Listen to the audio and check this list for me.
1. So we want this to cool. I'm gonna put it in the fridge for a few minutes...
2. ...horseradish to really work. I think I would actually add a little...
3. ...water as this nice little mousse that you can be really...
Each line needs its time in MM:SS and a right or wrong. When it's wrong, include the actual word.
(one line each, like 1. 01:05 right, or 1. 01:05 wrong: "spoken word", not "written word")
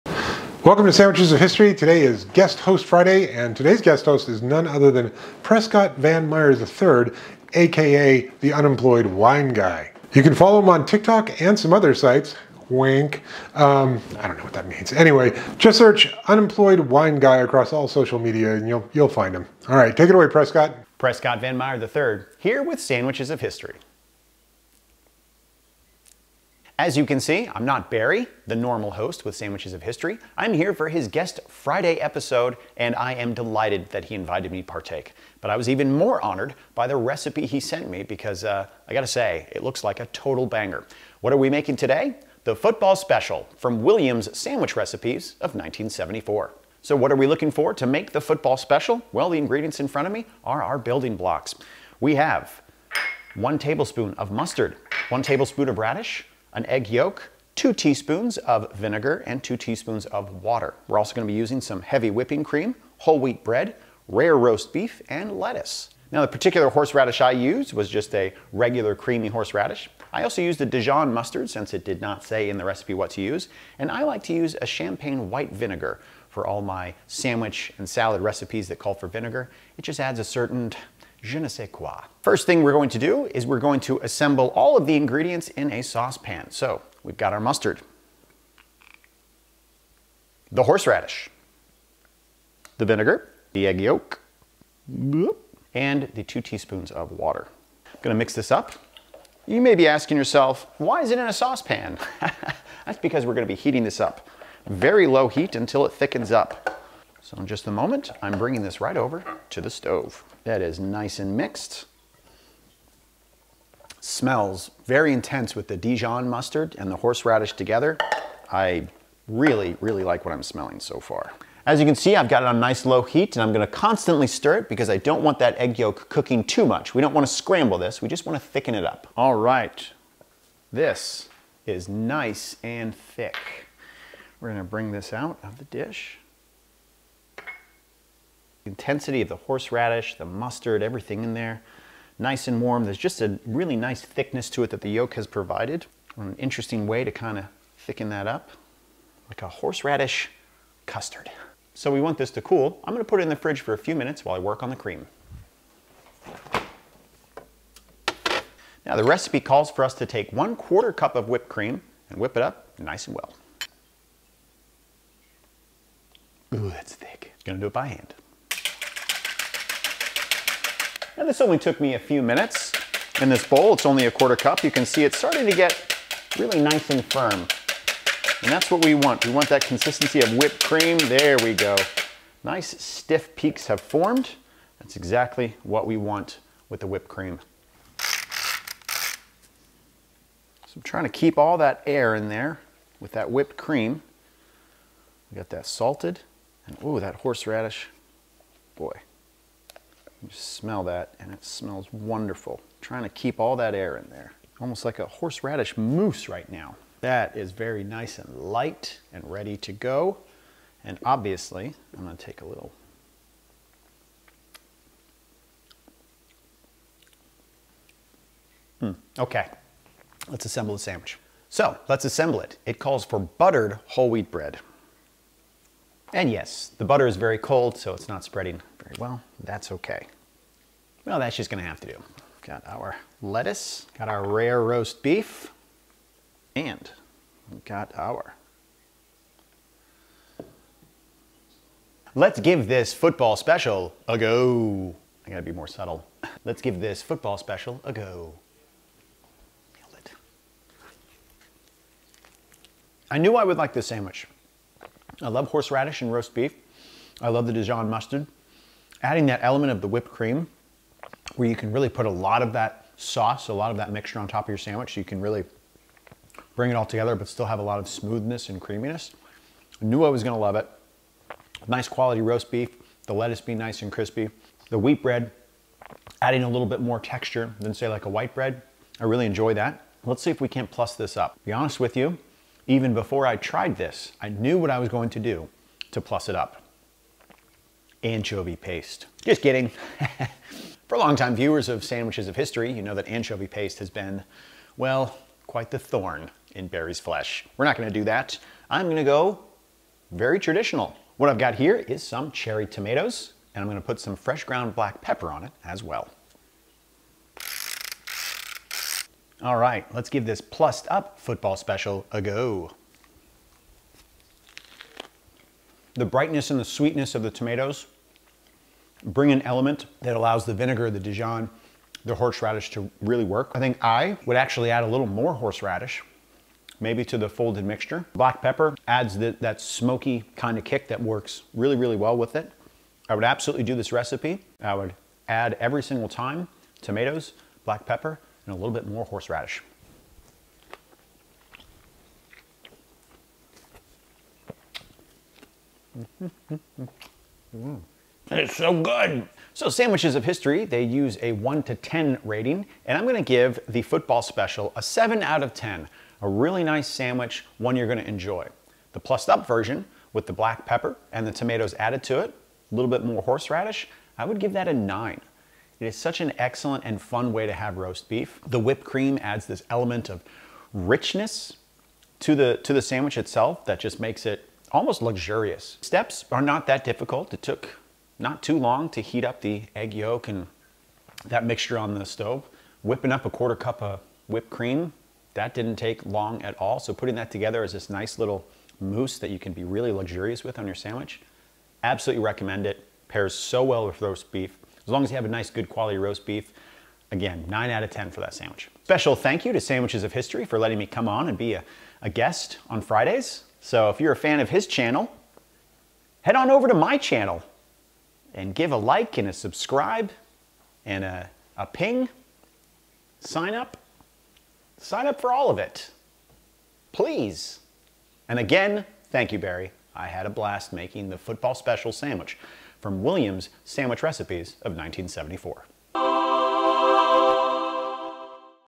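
1. 02:31 right
2. 05:22 right
3. 06:27 wrong: "together", not "water".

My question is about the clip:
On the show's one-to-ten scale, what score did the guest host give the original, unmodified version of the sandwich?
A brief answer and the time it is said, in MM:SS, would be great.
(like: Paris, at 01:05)
7, at 05:54.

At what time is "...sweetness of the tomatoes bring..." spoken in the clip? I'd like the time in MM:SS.
05:16.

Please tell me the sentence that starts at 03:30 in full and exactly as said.
And obviously, I'm gonna take a little.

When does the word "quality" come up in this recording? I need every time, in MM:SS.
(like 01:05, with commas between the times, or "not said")
04:31, 06:35.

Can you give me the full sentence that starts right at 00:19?
All right, take it away, Prescott.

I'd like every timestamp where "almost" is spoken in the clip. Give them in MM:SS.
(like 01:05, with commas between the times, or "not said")
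03:24, 06:14.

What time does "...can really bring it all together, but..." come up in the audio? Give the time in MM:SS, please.
04:25.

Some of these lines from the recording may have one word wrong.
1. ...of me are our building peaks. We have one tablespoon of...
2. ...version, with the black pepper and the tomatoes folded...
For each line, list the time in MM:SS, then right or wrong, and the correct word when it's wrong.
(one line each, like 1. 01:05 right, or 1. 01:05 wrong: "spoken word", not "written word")
1. 00:50 wrong: "blocks", not "peaks"
2. 05:59 wrong: "added", not "folded".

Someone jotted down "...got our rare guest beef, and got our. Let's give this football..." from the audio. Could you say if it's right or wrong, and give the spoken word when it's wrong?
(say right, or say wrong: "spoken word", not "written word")
wrong: "roast", not "guest".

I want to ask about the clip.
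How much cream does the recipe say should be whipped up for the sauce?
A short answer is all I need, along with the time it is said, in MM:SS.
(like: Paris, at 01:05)
One quarter cup, at 02:40.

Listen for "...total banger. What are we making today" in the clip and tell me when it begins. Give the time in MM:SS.
00:40.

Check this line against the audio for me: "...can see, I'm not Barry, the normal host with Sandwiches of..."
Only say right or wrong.
right.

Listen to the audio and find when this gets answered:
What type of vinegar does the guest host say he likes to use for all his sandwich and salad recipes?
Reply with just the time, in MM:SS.
01:14.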